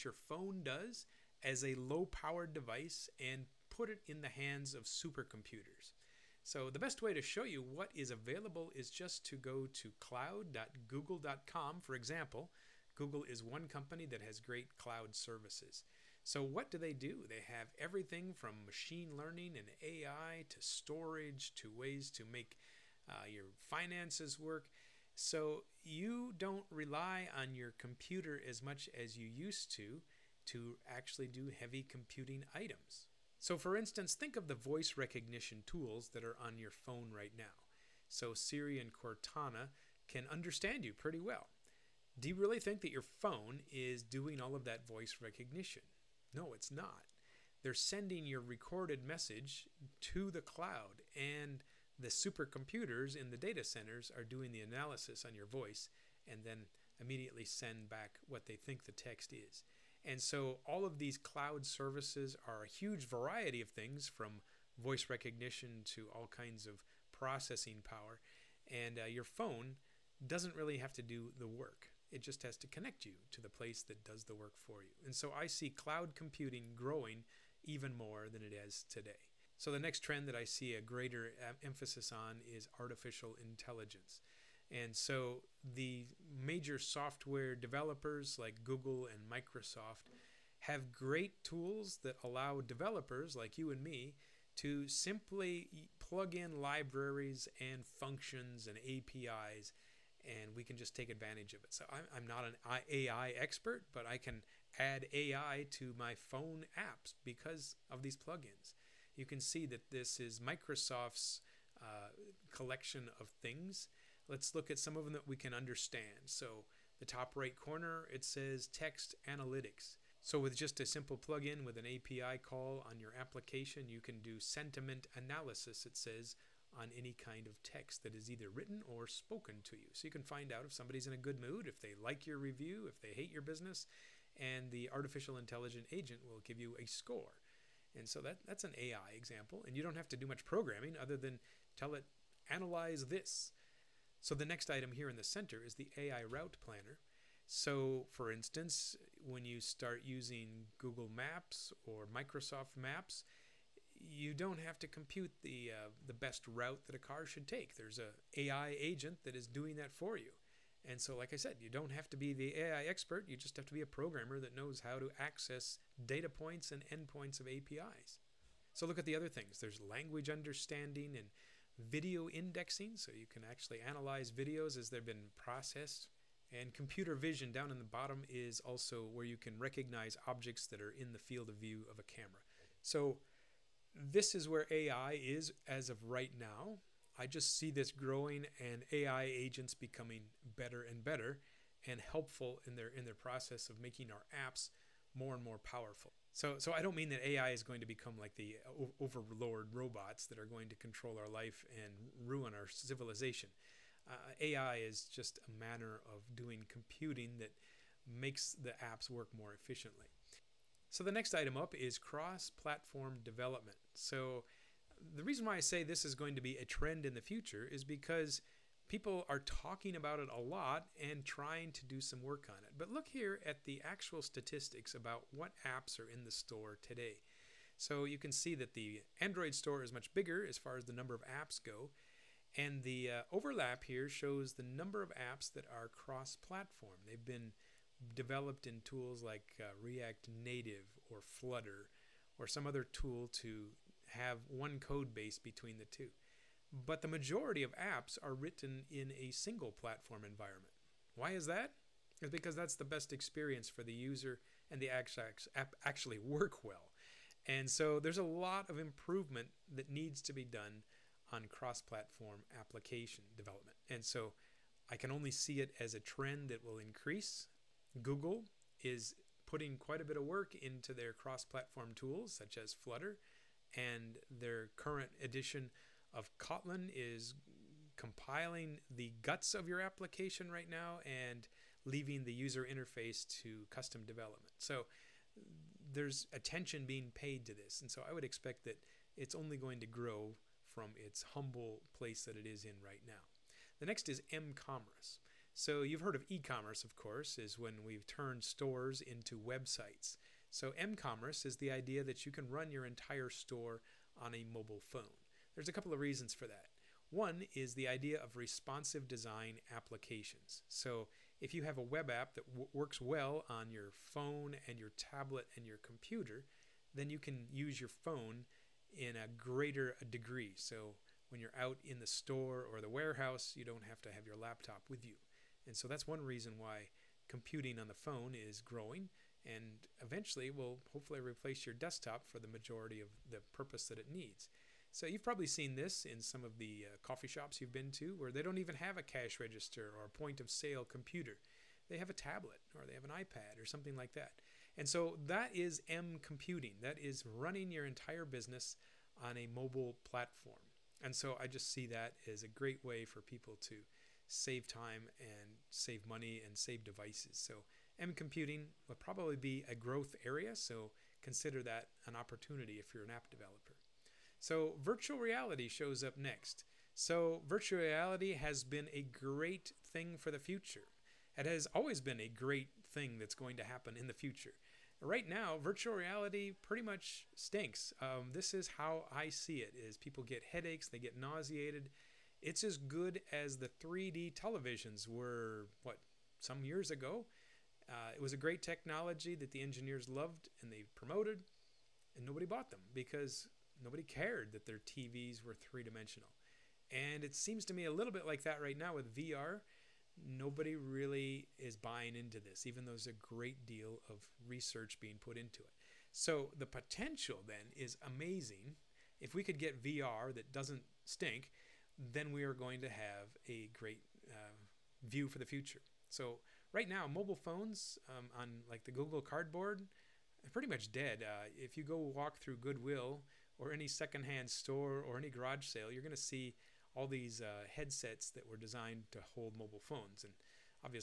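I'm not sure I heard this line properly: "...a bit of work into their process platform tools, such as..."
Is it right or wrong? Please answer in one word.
wrong.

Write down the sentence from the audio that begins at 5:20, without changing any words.
So, when you're out in the store or the warehouse, you don't have to have your laptop with you.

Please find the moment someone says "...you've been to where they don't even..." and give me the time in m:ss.
5:37.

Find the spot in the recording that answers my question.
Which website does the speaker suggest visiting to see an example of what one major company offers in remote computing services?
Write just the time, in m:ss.
0:09.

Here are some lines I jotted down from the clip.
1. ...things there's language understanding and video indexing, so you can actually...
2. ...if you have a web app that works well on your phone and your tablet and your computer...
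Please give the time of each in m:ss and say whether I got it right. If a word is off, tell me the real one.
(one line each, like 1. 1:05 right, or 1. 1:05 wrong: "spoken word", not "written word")
1. 2:49 right
2. 5:11 right.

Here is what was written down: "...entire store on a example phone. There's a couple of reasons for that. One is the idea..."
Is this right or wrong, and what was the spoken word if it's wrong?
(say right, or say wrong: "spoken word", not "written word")
wrong: "mobile", not "example".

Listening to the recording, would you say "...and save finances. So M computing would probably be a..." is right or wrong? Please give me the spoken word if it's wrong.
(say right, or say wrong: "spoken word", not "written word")
wrong: "devices", not "finances".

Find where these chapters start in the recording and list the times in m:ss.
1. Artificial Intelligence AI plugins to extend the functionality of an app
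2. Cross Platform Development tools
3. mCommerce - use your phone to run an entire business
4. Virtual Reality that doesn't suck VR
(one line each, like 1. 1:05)
1. 1:17
2. 3:30
3. 4:52
4. 6:02.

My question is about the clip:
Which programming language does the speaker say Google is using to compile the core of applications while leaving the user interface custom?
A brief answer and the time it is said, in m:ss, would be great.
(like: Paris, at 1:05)
Kotlin, at 4:36.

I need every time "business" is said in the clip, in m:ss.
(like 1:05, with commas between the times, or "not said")
2:13, 5:48.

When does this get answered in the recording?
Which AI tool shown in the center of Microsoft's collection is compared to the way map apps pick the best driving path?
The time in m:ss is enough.
2:25.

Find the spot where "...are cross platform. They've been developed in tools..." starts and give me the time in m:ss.
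3:55.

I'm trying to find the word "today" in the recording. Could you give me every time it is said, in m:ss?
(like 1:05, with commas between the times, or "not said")
1:18, 3:46.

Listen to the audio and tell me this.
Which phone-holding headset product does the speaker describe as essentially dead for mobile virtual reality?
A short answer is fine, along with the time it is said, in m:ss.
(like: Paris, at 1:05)
Google Cardboard, at 6:58.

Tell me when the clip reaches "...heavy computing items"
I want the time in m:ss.
0:31.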